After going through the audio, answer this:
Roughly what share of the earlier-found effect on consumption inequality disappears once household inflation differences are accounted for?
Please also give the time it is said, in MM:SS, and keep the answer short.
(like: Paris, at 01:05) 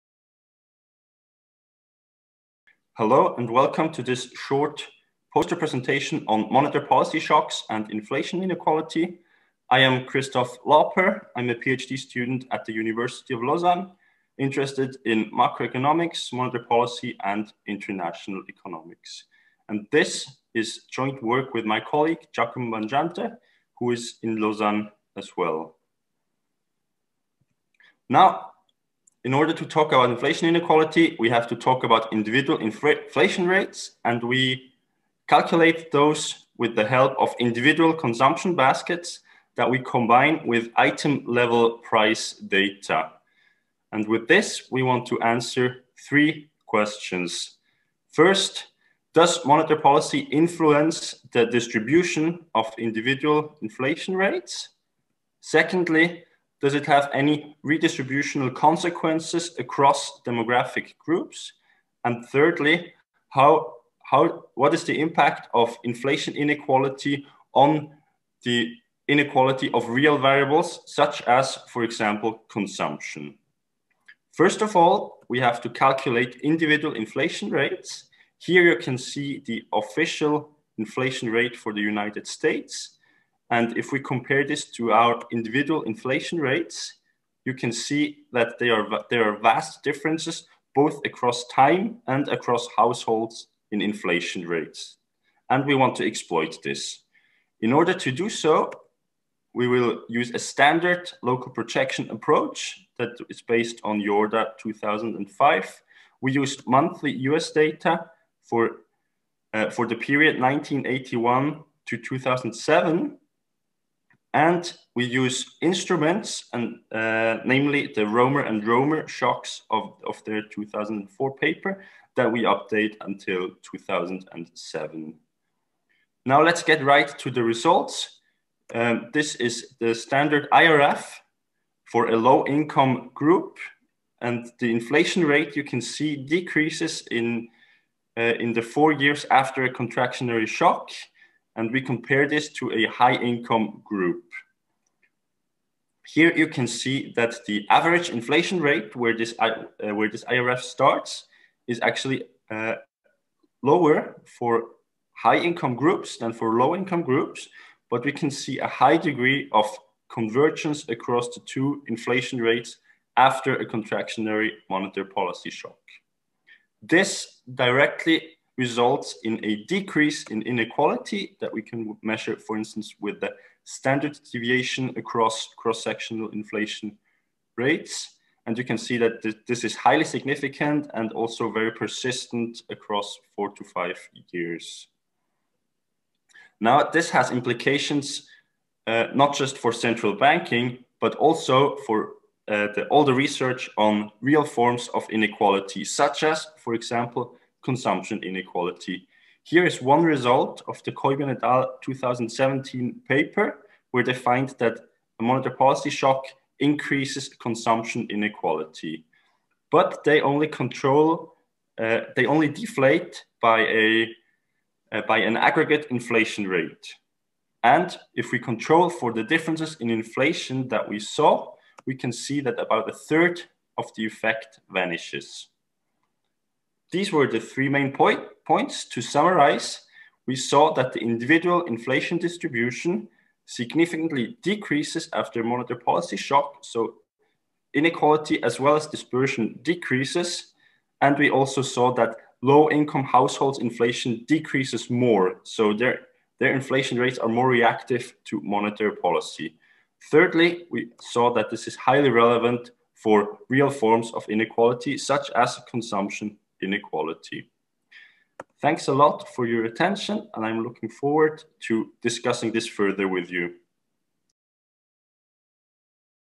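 a third, at 03:42.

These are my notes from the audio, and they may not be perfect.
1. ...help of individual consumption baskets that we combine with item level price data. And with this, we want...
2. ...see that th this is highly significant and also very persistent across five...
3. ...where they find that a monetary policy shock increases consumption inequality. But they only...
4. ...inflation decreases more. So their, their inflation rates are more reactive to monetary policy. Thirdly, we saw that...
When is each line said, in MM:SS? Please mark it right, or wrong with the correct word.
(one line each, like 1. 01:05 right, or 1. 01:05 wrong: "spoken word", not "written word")
1. 00:36 right
2. 02:58 wrong: "four", not "five"
3. 03:23 right
4. 04:03 right.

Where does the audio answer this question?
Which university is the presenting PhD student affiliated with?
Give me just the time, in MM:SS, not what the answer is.
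00:12.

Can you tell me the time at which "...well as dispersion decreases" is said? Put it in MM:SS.
03:58.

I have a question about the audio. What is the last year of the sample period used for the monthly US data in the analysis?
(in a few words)
2007.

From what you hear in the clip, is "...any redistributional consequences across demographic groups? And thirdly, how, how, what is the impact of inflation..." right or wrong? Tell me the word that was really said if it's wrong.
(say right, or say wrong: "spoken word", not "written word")
right.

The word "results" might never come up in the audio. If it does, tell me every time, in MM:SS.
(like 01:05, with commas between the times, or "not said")
02:07, 02:48, 03:20.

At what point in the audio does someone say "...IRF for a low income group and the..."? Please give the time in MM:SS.
02:10.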